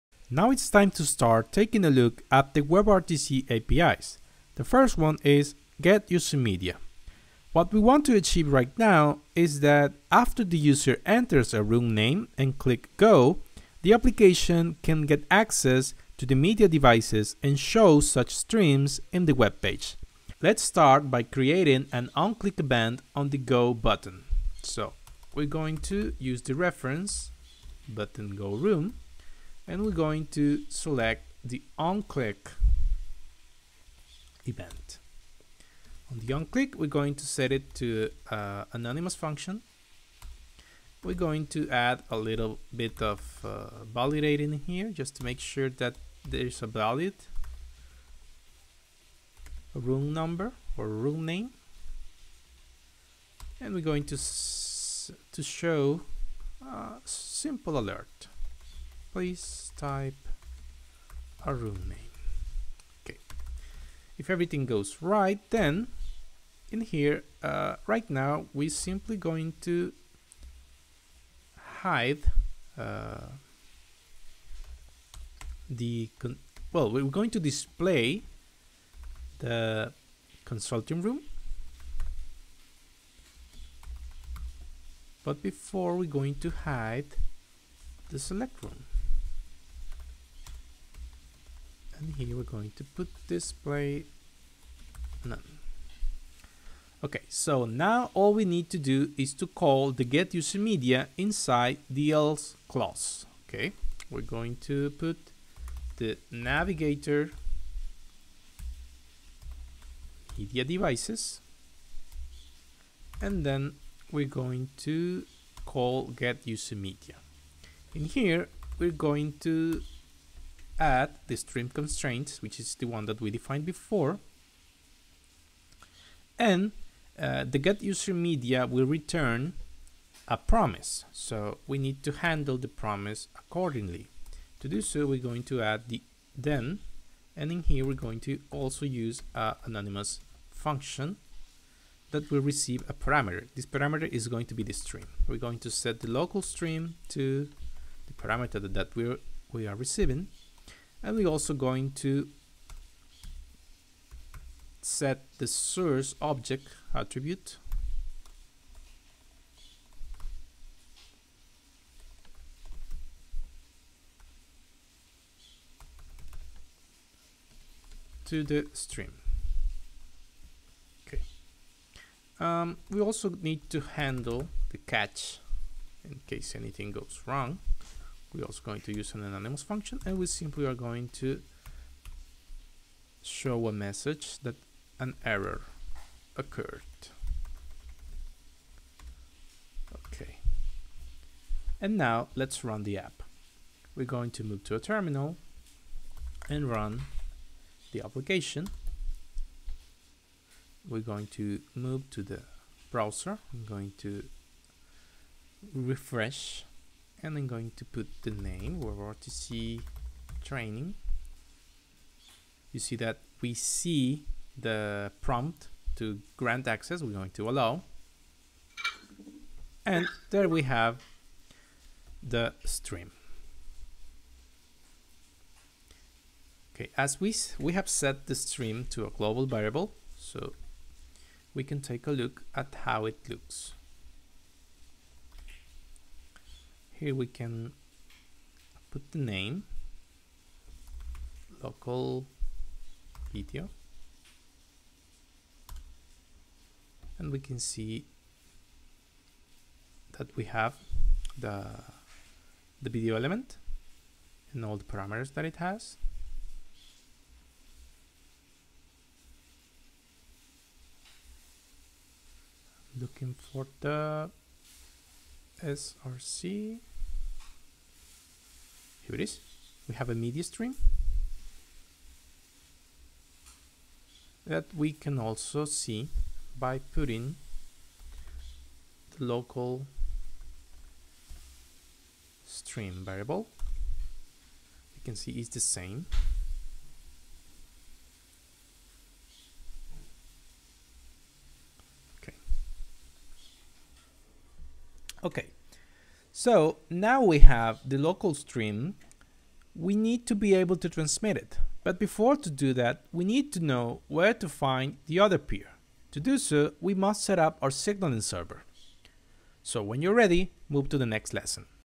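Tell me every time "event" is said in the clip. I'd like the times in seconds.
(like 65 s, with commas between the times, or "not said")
22 s, 34 s.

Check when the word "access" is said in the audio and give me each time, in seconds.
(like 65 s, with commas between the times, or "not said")
15 s, 216 s.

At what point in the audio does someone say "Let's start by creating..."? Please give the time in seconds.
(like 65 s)
20 s.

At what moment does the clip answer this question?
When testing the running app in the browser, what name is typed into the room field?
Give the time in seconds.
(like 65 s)
208 s.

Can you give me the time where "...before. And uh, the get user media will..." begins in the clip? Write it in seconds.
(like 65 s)
123 s.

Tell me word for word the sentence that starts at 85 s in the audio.
But before we're going to hide the select room.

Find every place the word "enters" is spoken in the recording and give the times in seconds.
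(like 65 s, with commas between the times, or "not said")
11 s.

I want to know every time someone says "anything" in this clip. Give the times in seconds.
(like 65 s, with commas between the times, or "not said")
176 s.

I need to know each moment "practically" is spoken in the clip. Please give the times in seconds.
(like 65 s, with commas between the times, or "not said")
not said.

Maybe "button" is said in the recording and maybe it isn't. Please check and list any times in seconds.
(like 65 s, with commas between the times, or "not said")
23 s, 27 s.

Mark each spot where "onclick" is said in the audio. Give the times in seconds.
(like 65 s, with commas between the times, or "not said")
22 s, 31 s, 36 s.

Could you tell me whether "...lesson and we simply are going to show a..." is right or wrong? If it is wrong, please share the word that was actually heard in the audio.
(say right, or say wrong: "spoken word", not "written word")
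wrong: "function", not "lesson".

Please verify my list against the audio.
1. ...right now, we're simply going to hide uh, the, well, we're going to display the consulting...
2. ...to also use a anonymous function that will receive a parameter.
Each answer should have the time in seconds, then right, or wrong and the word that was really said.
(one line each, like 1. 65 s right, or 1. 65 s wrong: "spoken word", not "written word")
1. 67 s right
2. 138 s right.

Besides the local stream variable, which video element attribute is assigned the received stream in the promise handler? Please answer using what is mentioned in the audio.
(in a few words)
Source object.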